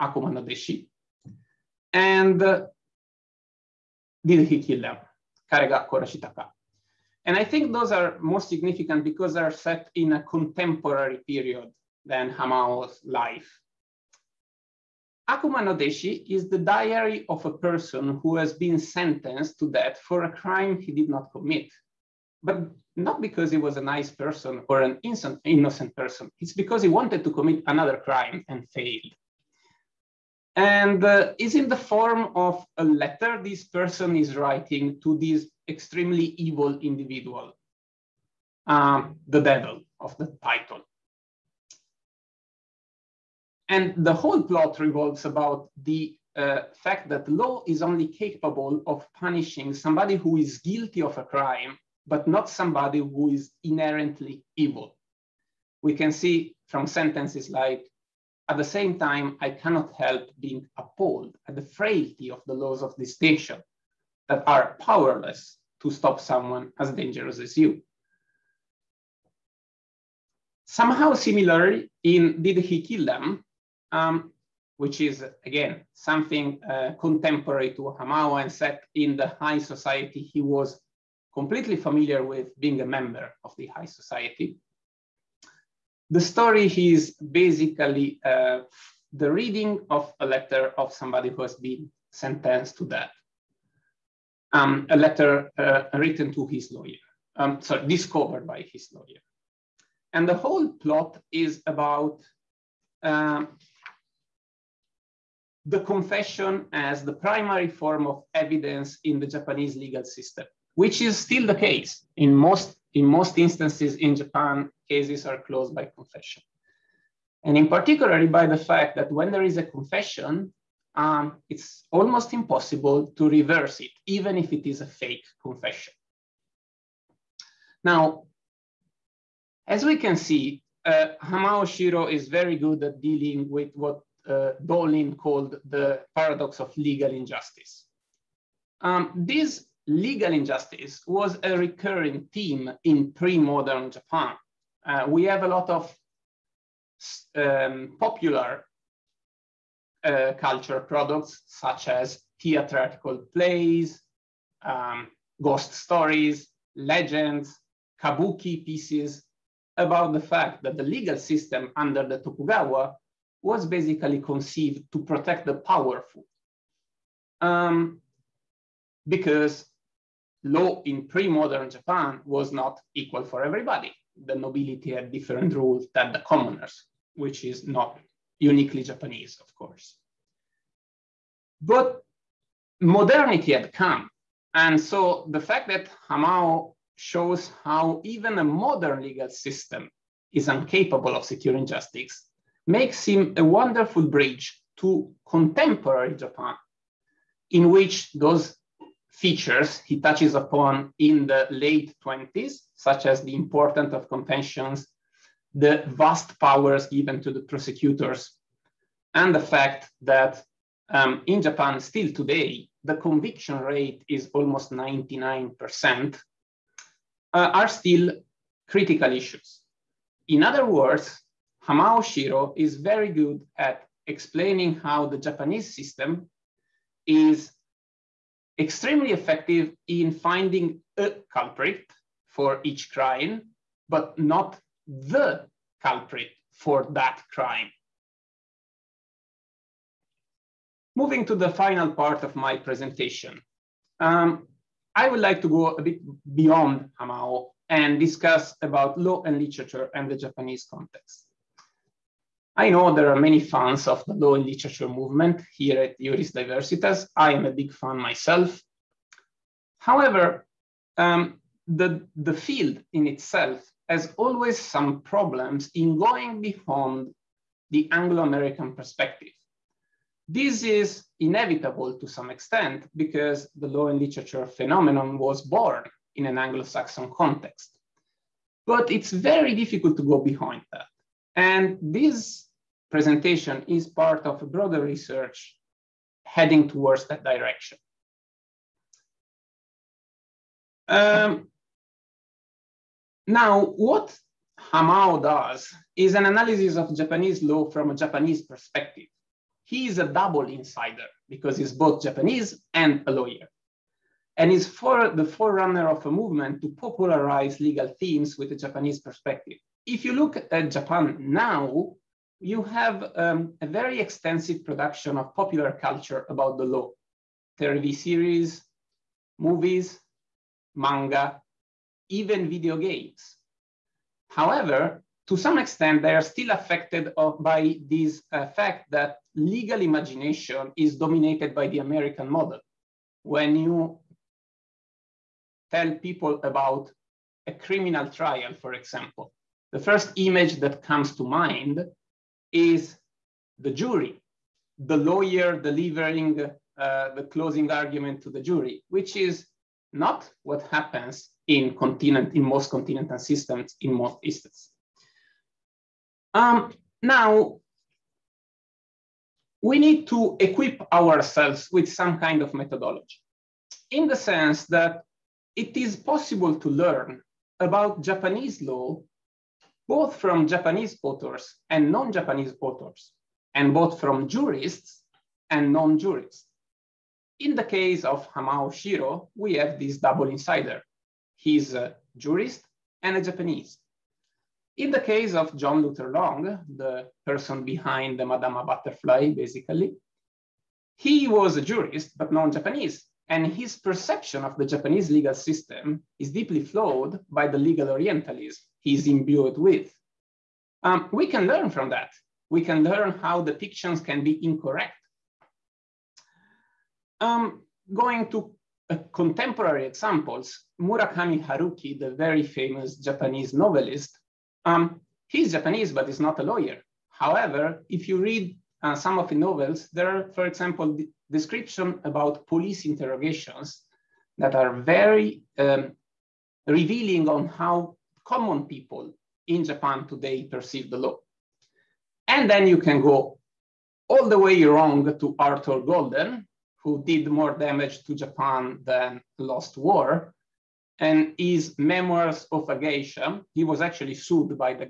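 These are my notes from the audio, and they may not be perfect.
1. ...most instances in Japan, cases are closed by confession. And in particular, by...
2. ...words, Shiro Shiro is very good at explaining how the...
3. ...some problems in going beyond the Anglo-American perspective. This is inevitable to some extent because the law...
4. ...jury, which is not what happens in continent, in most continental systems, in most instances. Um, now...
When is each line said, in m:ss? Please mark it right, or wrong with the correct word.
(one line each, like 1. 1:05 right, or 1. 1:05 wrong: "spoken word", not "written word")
1. 1:53 right
2. 3:40 wrong: "Hamao", not "Shiro"
3. 4:24 right
4. 5:48 right.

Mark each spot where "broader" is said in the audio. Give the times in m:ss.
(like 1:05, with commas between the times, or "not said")
4:44.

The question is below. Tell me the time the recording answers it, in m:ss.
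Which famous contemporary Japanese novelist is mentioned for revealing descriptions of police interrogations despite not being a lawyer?
6:50.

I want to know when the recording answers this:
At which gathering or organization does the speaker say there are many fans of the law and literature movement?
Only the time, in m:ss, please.
4:15.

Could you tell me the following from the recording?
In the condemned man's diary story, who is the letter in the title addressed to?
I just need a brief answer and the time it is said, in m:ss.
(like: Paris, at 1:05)
The devil, at 0:39.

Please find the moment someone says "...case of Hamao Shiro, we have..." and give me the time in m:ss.
6:17.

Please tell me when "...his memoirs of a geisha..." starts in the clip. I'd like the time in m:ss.
7:21.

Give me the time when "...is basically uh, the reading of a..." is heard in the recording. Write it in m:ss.
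1:26.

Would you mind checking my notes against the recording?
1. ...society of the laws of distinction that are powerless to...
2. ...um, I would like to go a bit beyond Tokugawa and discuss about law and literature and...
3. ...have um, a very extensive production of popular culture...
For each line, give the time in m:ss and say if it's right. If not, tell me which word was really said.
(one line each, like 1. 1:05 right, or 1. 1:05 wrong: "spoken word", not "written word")
1. 1:01 wrong: "frailty", not "society"
2. 4:03 wrong: "Hamao", not "Tokugawa"
3. 5:12 right.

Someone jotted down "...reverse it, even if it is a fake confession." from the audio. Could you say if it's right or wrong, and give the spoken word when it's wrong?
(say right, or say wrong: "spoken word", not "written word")
right.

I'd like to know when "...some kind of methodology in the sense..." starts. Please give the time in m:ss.
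6:01.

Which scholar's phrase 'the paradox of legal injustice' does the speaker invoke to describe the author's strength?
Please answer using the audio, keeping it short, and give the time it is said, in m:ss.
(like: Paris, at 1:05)
Dolin, at 2:14.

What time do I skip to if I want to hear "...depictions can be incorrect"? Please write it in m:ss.
6:43.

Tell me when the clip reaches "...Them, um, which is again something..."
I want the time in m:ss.
1:13.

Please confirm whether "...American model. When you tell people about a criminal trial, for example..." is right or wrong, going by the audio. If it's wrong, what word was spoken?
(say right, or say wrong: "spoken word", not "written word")
right.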